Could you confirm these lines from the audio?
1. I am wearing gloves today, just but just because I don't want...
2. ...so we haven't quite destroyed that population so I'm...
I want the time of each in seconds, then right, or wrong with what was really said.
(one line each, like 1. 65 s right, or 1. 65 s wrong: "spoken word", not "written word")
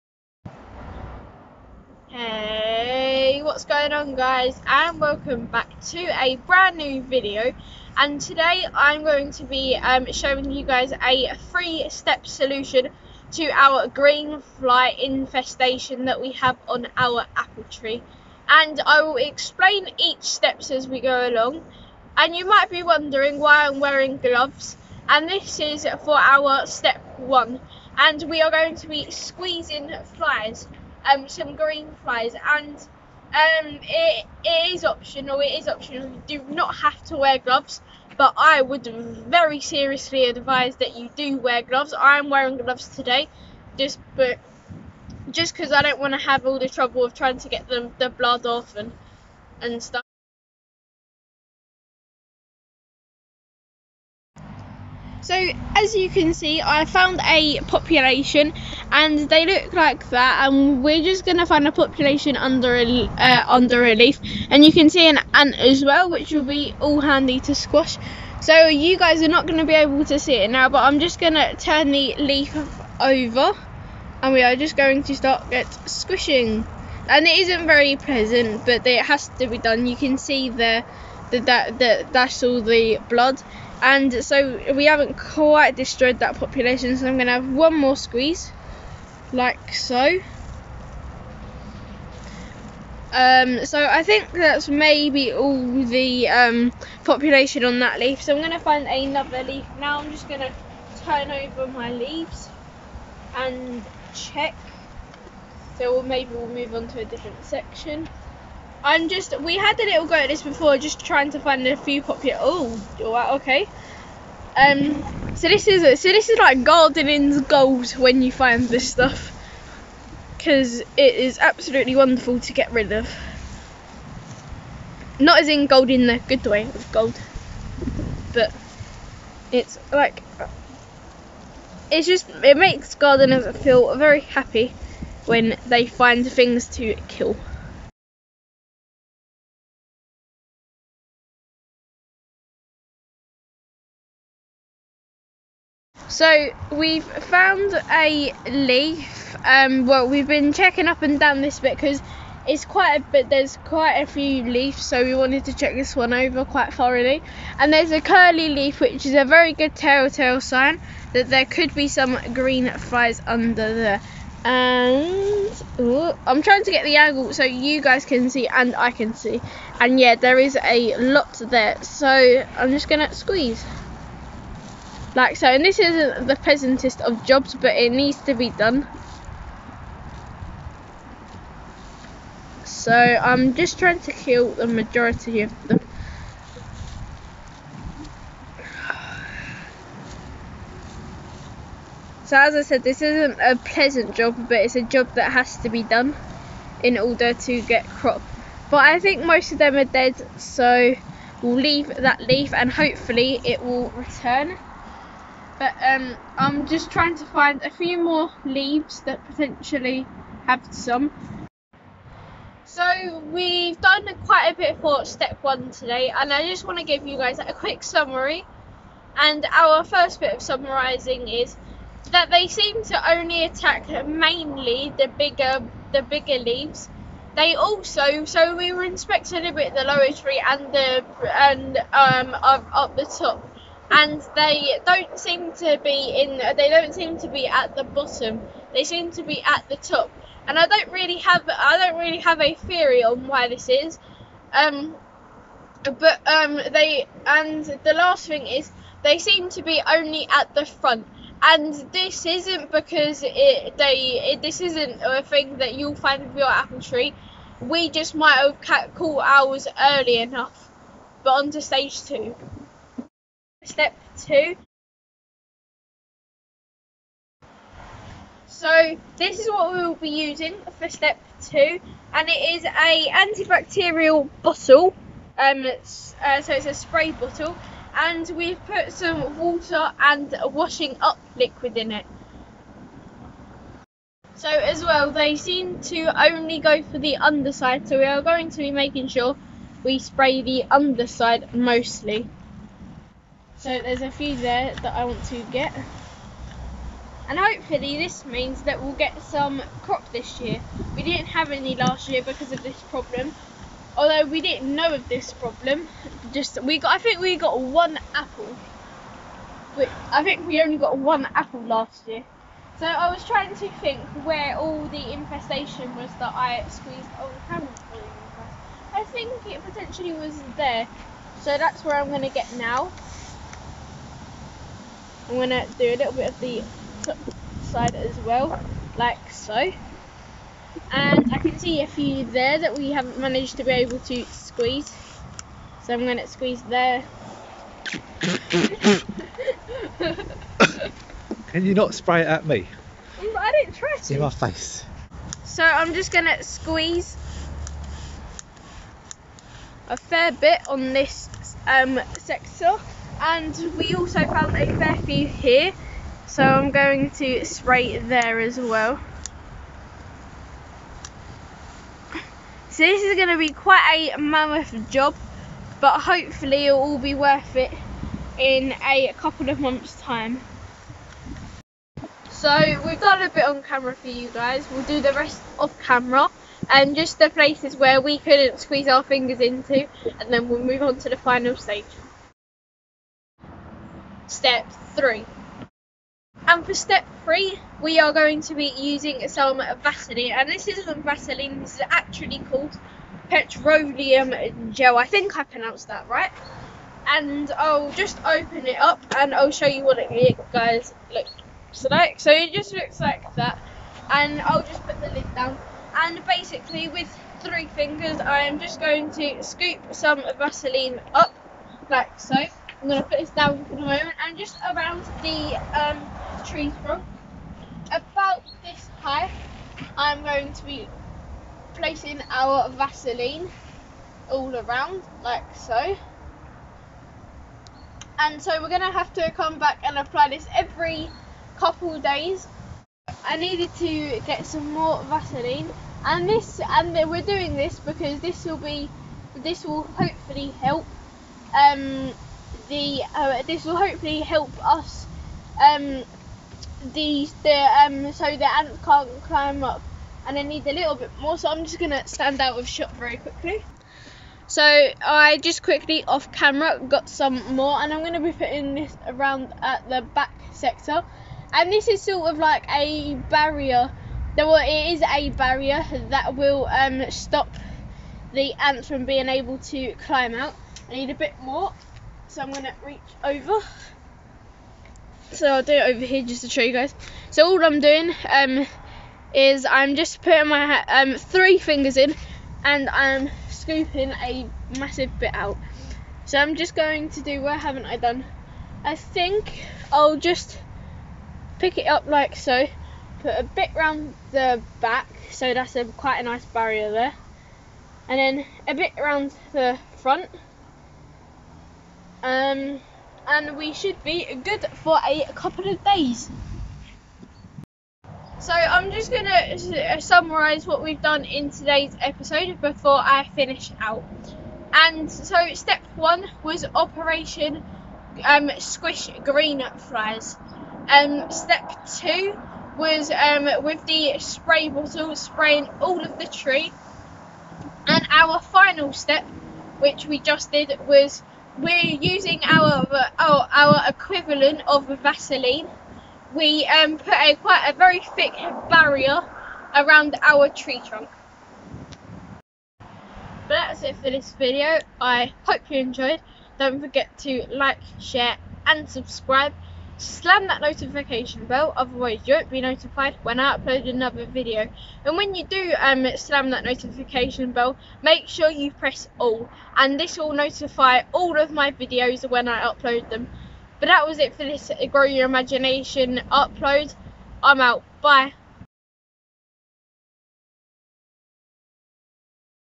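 1. 41 s right
2. 84 s right.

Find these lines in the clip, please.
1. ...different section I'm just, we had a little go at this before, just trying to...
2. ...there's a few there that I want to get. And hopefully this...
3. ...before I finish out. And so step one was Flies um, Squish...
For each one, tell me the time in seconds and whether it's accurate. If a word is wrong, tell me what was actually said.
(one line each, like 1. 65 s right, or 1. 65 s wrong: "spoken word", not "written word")
1. 107 s right
2. 293 s right
3. 512 s wrong: "Operation", not "Flies".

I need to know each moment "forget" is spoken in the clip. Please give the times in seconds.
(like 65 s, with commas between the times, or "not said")
546 s.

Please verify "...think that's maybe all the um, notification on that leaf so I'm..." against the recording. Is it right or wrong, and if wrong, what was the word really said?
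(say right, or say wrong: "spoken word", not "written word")
wrong: "population", not "notification".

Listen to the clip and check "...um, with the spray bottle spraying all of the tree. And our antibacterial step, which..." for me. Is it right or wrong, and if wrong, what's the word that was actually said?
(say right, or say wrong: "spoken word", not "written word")
wrong: "final", not "antibacterial".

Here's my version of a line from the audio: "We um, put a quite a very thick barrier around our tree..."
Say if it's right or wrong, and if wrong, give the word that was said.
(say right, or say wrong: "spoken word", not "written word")
right.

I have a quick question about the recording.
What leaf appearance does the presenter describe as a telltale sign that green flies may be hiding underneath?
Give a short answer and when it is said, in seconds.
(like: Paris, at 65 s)
Curly leaf, at 158 s.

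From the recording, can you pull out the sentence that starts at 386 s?
And for step three, we are going to be using some Vaseline.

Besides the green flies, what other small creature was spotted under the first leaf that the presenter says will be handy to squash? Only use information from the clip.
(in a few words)
An ant.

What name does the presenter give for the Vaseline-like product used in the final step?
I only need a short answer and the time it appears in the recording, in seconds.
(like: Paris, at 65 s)
Petroleum gel, at 393 s.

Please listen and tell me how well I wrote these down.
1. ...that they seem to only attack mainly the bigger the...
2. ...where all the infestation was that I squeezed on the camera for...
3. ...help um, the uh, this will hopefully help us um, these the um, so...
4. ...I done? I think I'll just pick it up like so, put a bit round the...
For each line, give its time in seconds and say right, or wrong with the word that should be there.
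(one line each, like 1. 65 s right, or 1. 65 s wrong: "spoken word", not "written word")
1. 222 s right
2. 314 s right
3. 440 s right
4. 487 s right.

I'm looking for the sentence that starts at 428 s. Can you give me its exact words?
And so we're going to have to come back and apply this every couple days.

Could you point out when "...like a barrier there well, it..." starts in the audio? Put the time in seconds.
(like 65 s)
462 s.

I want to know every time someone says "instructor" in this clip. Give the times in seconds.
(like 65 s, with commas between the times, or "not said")
not said.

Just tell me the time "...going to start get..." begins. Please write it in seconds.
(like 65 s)
74 s.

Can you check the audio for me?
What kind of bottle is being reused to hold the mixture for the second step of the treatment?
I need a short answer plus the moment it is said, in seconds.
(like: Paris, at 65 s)
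Antibacterial bottle, at 273 s.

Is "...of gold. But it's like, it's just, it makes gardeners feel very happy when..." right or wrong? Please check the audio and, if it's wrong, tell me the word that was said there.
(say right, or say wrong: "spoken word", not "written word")
right.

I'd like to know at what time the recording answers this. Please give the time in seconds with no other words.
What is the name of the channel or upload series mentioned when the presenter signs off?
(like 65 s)
564 s.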